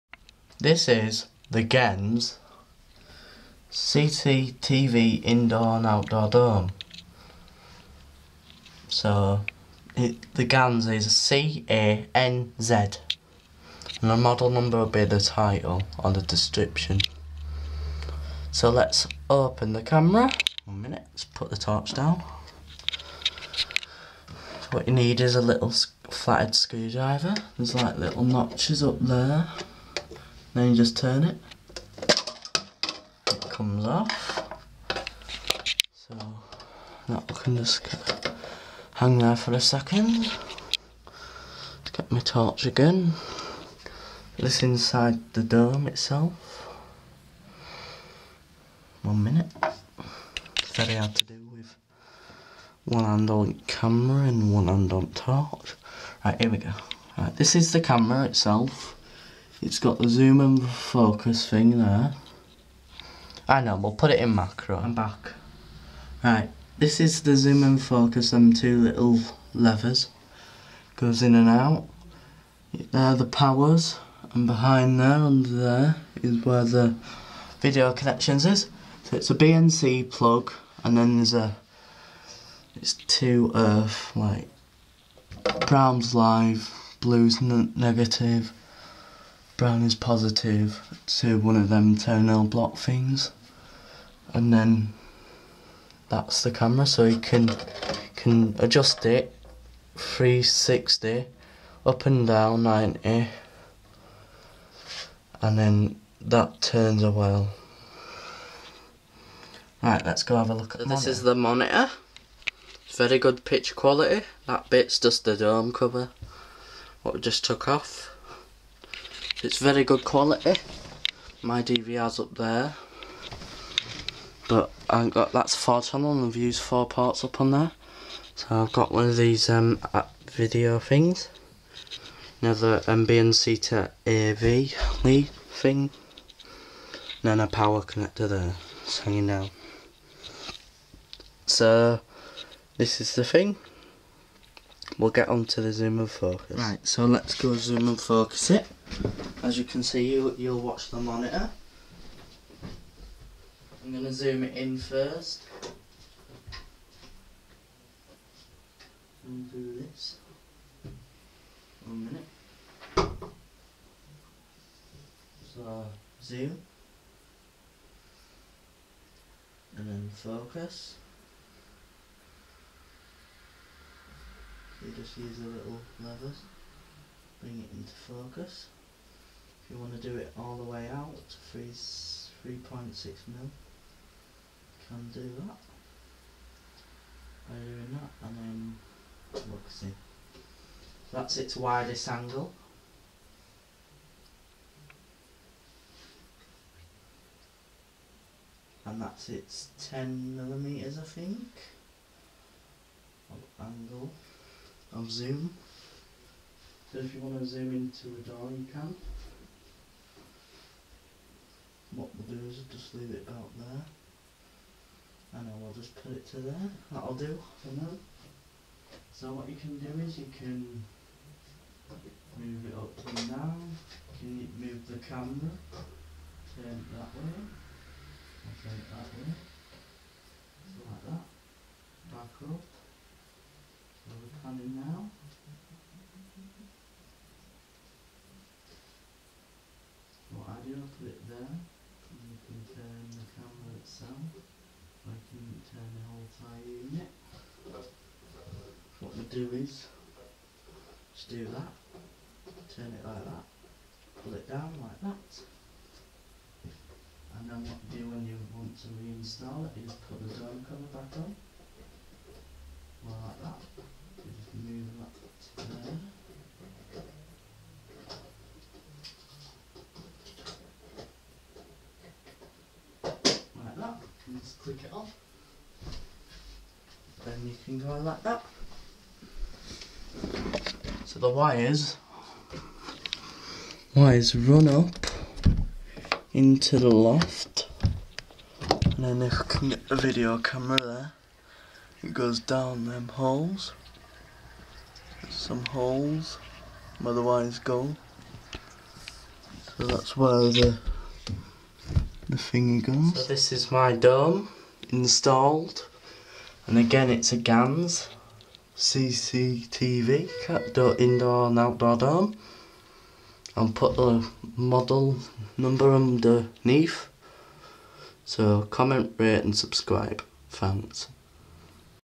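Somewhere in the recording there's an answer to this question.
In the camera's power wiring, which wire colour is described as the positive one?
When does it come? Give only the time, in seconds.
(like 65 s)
89 s.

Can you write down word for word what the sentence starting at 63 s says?
I know, we'll put it in macro.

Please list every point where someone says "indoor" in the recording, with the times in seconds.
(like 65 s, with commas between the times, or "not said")
5 s, 310 s.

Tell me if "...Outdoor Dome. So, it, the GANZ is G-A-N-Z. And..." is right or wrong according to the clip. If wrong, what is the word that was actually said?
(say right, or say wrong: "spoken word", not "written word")
right.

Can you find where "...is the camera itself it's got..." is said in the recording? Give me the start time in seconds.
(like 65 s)
57 s.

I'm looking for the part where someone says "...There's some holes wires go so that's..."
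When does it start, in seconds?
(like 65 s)
295 s.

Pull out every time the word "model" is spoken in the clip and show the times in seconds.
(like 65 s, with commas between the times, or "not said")
14 s, 314 s.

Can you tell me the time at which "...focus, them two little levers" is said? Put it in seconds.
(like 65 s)
67 s.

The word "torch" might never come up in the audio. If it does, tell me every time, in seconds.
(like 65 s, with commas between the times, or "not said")
21 s, 42 s, 55 s.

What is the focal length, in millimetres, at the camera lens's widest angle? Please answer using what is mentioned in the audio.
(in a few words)
3.6 mm.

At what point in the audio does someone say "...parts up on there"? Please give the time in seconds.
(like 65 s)
126 s.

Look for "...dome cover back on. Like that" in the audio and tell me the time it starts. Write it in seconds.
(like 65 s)
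260 s.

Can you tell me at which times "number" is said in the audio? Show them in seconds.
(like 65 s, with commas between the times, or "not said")
14 s, 315 s.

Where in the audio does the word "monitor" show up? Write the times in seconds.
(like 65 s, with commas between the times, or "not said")
111 s, 150 s.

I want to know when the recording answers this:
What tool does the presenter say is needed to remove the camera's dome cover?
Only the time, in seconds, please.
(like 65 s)
25 s.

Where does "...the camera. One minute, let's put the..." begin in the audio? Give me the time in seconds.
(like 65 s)
19 s.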